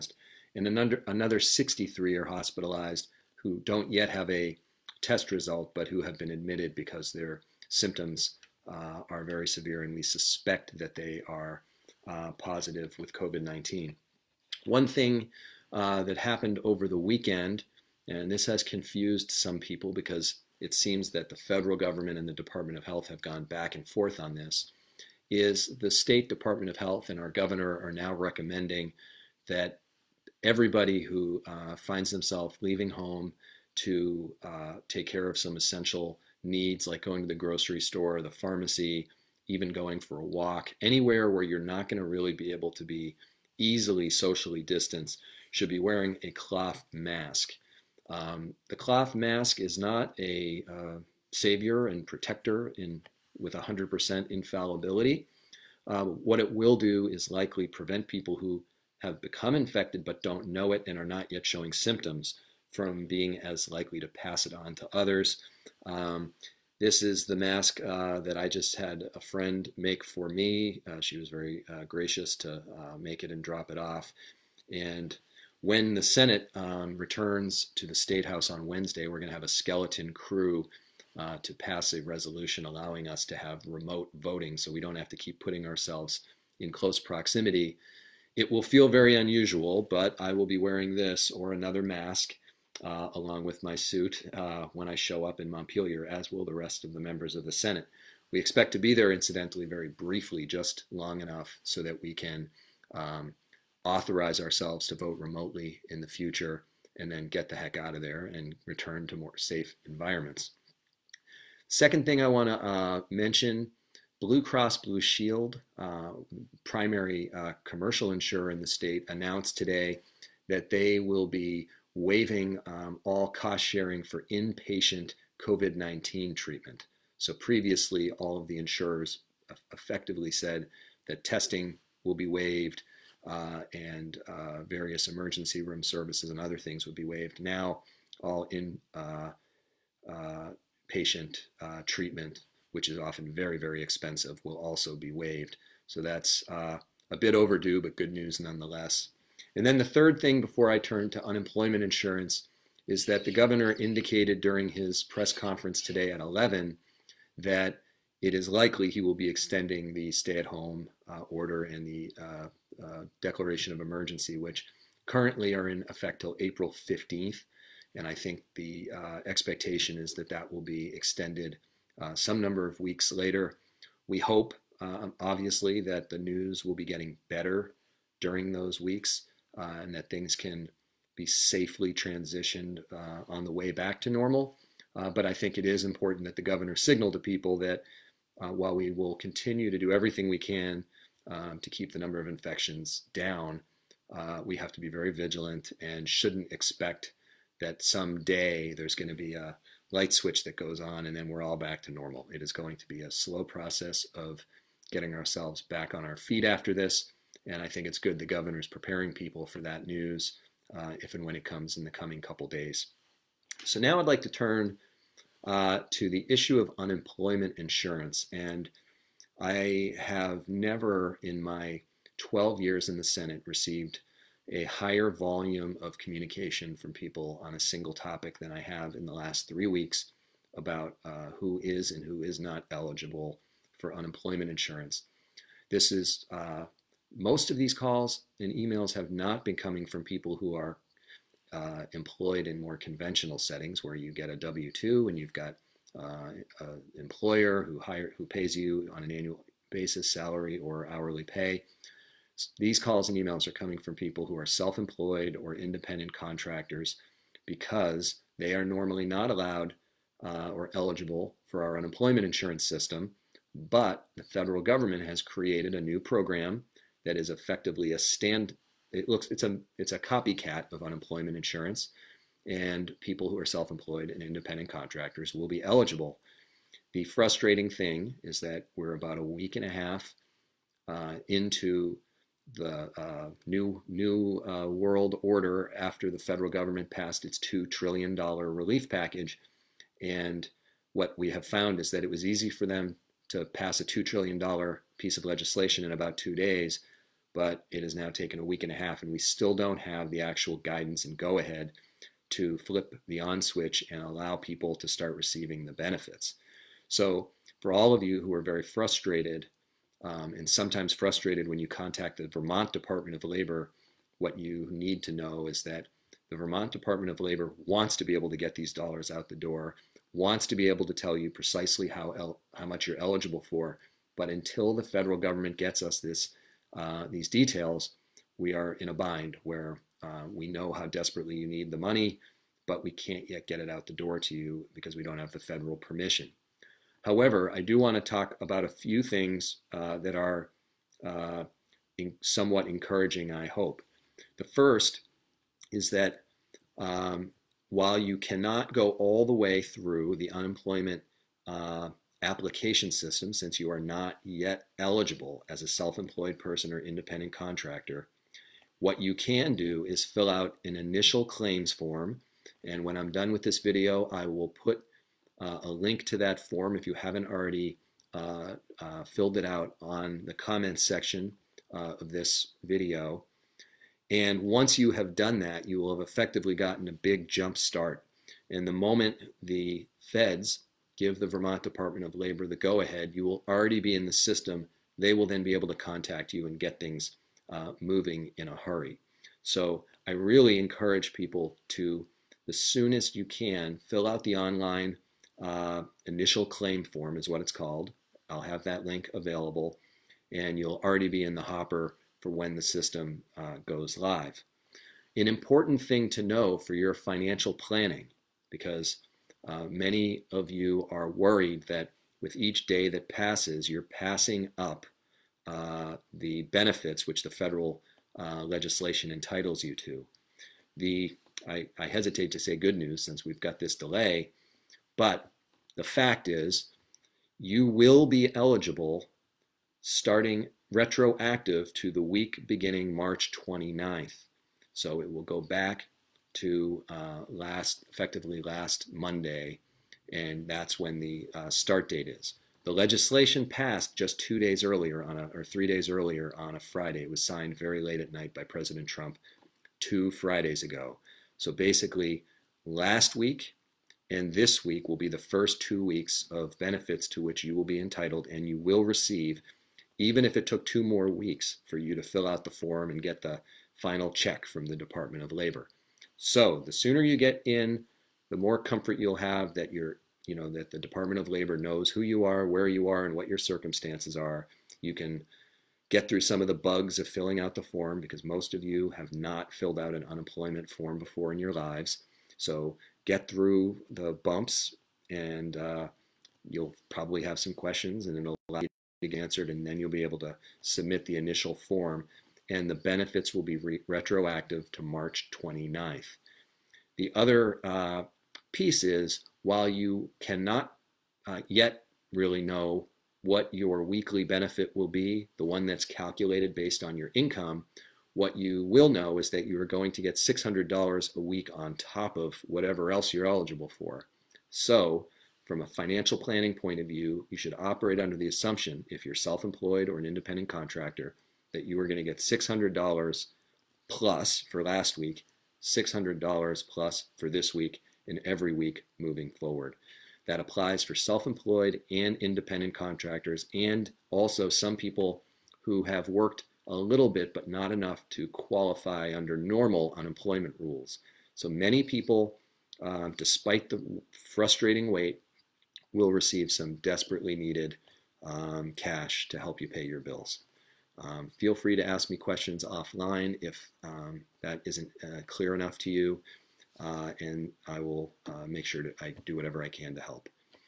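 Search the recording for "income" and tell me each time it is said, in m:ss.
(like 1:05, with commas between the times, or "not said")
8:27.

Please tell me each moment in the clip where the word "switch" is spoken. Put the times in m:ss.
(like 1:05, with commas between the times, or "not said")
3:20, 5:03.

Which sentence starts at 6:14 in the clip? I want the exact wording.
And once you have done that, you will have effectively gotten a big jump start.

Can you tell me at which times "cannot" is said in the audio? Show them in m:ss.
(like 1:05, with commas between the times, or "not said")
5:48, 8:20.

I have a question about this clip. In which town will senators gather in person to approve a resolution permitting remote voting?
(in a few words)
Montpelier.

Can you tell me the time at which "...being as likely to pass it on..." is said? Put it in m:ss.
1:03.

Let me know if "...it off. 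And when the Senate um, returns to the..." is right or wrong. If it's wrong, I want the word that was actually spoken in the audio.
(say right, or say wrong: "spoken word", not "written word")
right.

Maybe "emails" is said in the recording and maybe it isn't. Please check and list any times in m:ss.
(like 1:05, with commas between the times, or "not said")
3:58, 4:13.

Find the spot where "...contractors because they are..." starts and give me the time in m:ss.
4:16.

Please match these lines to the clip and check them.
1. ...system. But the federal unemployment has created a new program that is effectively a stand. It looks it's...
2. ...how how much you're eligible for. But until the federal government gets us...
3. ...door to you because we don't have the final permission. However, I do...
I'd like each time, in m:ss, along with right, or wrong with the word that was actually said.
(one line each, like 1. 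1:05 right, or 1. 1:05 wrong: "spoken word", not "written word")
1. 4:22 wrong: "government", not "unemployment"
2. 5:21 right
3. 5:33 wrong: "federal", not "final".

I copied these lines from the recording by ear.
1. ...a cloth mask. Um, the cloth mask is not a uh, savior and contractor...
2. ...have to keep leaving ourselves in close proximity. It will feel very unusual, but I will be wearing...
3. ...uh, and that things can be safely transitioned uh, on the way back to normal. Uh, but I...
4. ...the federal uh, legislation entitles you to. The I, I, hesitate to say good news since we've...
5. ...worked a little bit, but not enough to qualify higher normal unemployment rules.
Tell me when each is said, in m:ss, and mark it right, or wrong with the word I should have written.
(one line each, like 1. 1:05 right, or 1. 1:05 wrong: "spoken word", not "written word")
1. 0:46 wrong: "protector", not "contractor"
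2. 1:24 wrong: "putting", not "leaving"
3. 2:59 right
4. 6:57 right
5. 8:56 wrong: "under", not "higher".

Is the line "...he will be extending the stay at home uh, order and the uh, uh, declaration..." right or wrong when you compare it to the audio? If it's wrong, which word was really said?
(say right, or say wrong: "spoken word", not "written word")
right.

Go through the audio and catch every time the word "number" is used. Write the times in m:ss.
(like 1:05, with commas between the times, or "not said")
2:52, 3:11.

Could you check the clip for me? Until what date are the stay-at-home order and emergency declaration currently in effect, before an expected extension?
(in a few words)
April 15th.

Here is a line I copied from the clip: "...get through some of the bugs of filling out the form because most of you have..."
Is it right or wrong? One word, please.
right.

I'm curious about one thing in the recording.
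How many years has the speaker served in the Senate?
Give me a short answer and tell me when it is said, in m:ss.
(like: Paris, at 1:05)
12, at 3:42.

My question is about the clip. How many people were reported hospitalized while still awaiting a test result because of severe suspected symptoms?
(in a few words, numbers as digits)
63.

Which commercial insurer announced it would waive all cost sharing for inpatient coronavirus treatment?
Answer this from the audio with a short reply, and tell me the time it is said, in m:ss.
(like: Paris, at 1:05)
Blue Cross Blue Shield, at 1:54.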